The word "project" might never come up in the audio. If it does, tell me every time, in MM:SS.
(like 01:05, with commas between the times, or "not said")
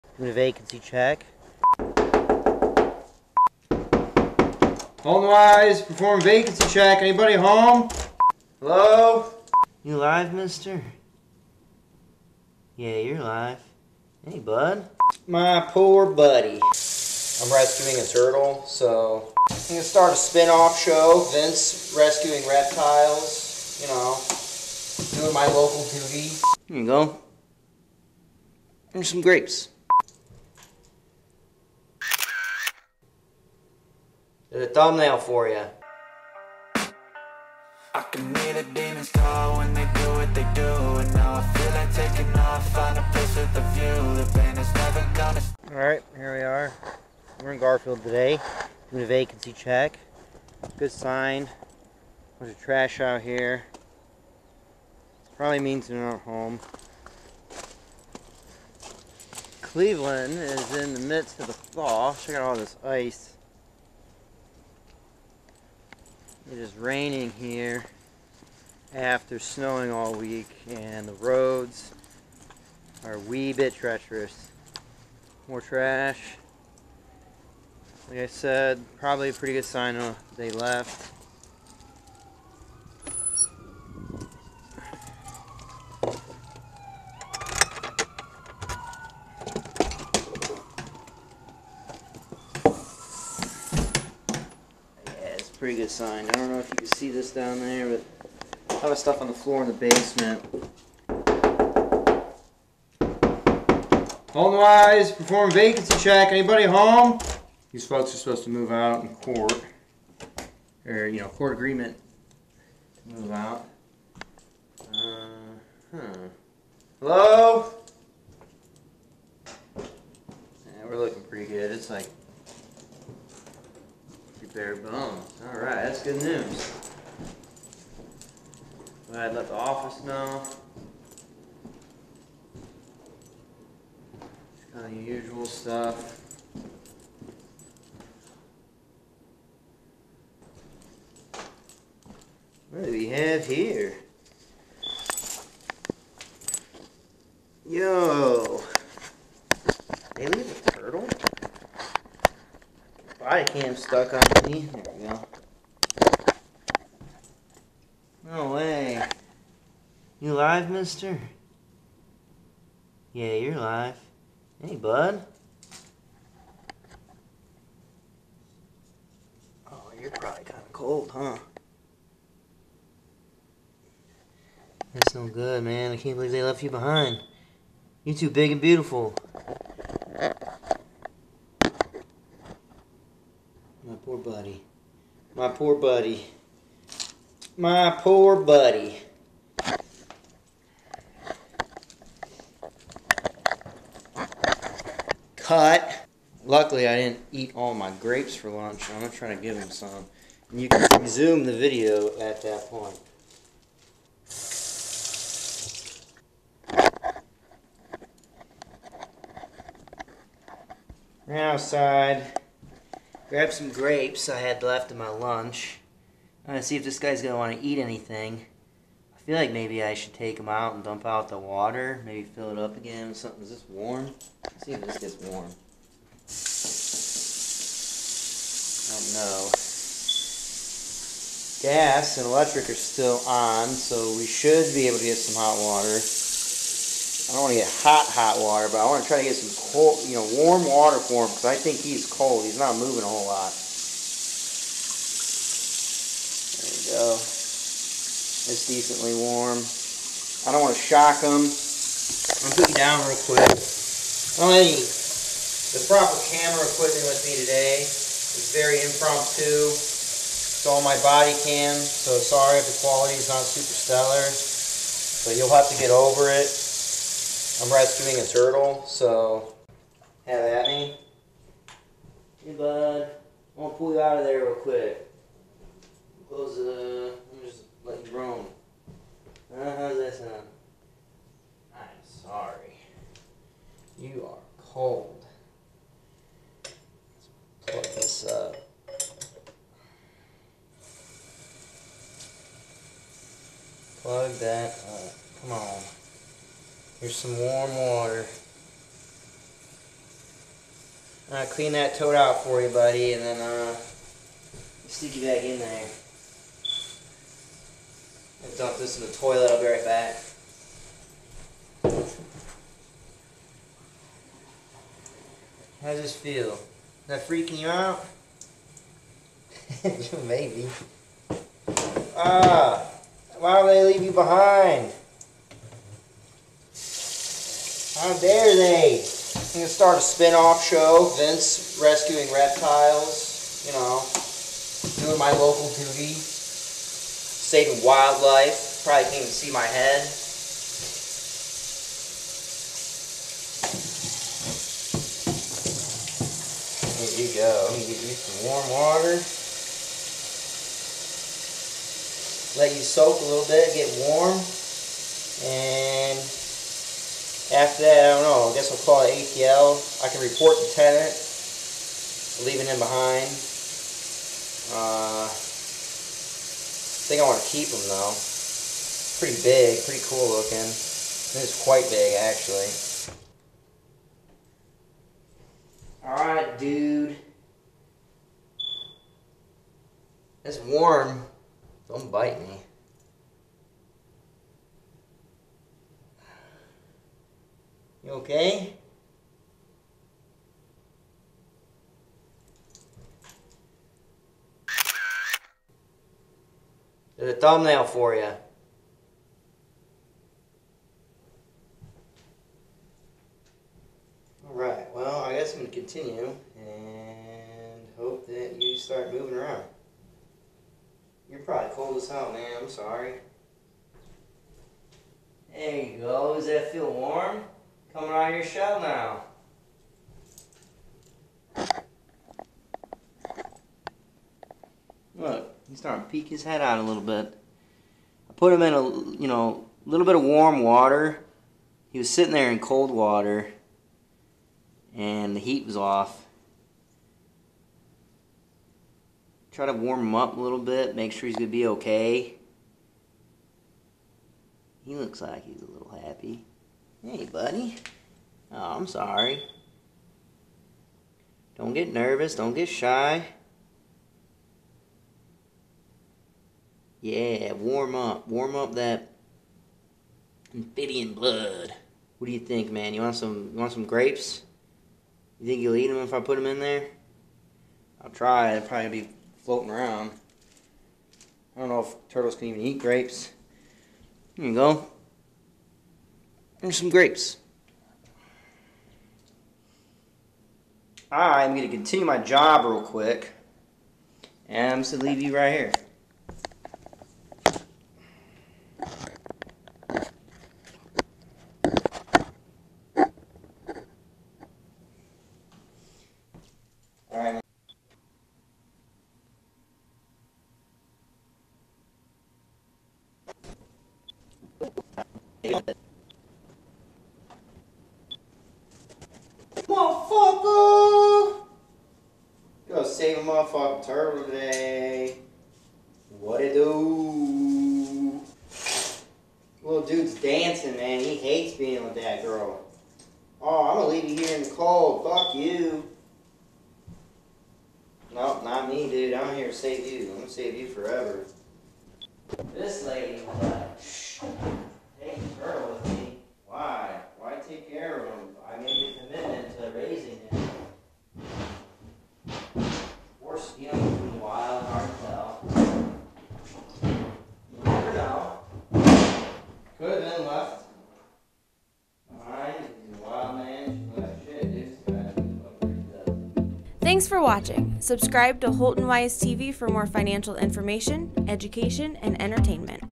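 not said.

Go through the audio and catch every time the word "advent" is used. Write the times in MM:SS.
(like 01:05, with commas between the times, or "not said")
not said.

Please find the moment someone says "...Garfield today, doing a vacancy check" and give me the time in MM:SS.
00:47.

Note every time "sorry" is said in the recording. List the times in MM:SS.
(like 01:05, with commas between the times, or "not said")
04:22, 04:42, 06:52, 07:28.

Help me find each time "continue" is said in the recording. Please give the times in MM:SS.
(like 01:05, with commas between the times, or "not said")
06:45, 08:01.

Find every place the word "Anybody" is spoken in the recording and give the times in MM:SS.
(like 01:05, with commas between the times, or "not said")
00:06, 01:46.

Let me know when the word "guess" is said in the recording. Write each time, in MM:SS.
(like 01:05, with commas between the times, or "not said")
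05:58, 06:45.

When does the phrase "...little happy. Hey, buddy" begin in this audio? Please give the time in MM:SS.
07:25.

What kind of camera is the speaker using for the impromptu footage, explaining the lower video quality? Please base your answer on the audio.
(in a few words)
Body cam.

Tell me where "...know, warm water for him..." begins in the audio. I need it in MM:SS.
04:00.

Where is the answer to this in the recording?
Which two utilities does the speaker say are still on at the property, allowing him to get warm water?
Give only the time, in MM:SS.
03:51.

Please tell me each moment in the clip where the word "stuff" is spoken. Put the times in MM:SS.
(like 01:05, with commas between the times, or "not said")
01:38, 02:15.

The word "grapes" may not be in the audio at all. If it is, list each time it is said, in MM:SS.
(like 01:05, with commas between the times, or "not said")
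00:29, 03:17, 03:33, 07:43, 07:52, 07:56.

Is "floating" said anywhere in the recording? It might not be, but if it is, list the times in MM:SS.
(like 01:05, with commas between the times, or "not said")
07:49.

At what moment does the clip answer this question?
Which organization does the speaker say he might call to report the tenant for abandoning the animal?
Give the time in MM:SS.
05:59.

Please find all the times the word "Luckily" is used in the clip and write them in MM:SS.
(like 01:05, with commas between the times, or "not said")
03:16.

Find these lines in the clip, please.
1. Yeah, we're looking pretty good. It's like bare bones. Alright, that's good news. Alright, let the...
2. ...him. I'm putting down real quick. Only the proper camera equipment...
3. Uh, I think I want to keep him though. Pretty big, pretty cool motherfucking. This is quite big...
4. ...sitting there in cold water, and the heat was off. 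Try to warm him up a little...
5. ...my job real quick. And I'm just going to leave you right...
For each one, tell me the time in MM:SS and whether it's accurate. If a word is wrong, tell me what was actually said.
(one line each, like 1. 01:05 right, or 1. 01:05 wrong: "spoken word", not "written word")
1. 01:59 right
2. 04:11 right
3. 06:04 wrong: "looking", not "motherfucking"
4. 07:12 right
5. 08:02 right.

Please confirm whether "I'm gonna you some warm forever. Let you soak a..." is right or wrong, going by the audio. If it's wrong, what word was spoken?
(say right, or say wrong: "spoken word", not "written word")
wrong: "water", not "forever".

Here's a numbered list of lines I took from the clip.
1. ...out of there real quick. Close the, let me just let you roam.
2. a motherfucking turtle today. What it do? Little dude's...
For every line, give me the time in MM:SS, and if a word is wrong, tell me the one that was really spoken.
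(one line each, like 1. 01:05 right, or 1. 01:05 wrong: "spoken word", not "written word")
1. 04:34 right
2. 08:33 right.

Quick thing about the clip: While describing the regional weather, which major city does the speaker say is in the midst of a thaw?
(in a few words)
Cleveland.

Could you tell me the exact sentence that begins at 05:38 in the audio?
Probably can't even see my head.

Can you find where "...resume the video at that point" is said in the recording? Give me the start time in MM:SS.
03:21.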